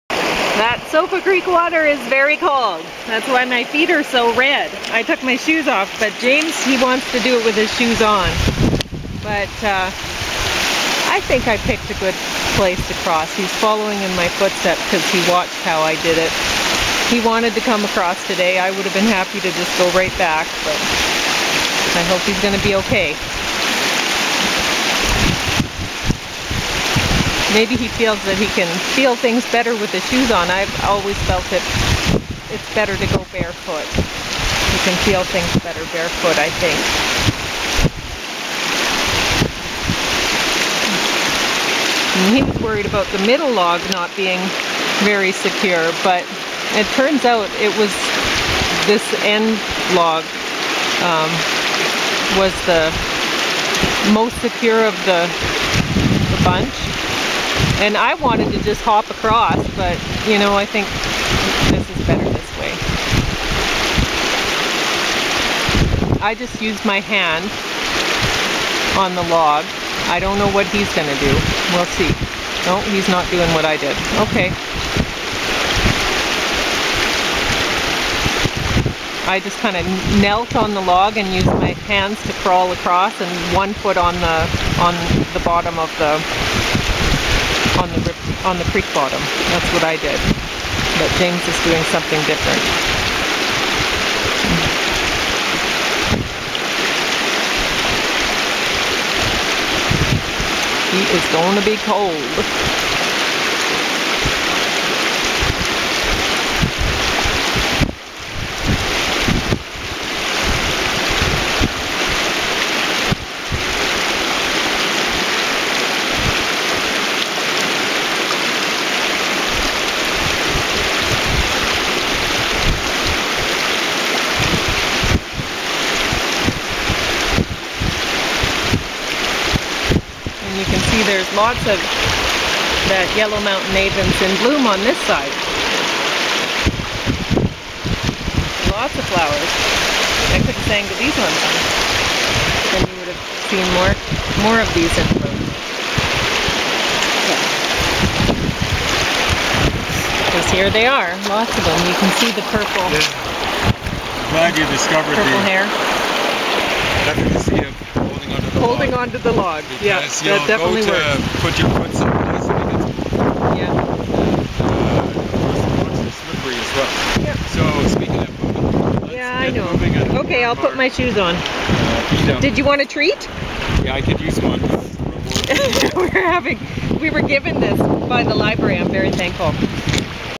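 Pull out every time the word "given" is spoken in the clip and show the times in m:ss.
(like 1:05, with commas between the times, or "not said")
2:57.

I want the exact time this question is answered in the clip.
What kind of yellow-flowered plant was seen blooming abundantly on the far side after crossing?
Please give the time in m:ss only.
2:13.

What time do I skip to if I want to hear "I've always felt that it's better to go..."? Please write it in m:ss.
0:30.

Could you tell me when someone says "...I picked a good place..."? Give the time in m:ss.
0:11.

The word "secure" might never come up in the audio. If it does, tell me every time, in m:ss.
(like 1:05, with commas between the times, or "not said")
0:45, 0:54.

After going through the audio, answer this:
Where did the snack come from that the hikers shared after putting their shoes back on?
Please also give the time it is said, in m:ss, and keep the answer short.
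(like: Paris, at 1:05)
the library, at 2:58.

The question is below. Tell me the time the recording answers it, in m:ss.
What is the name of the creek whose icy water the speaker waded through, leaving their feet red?
0:00.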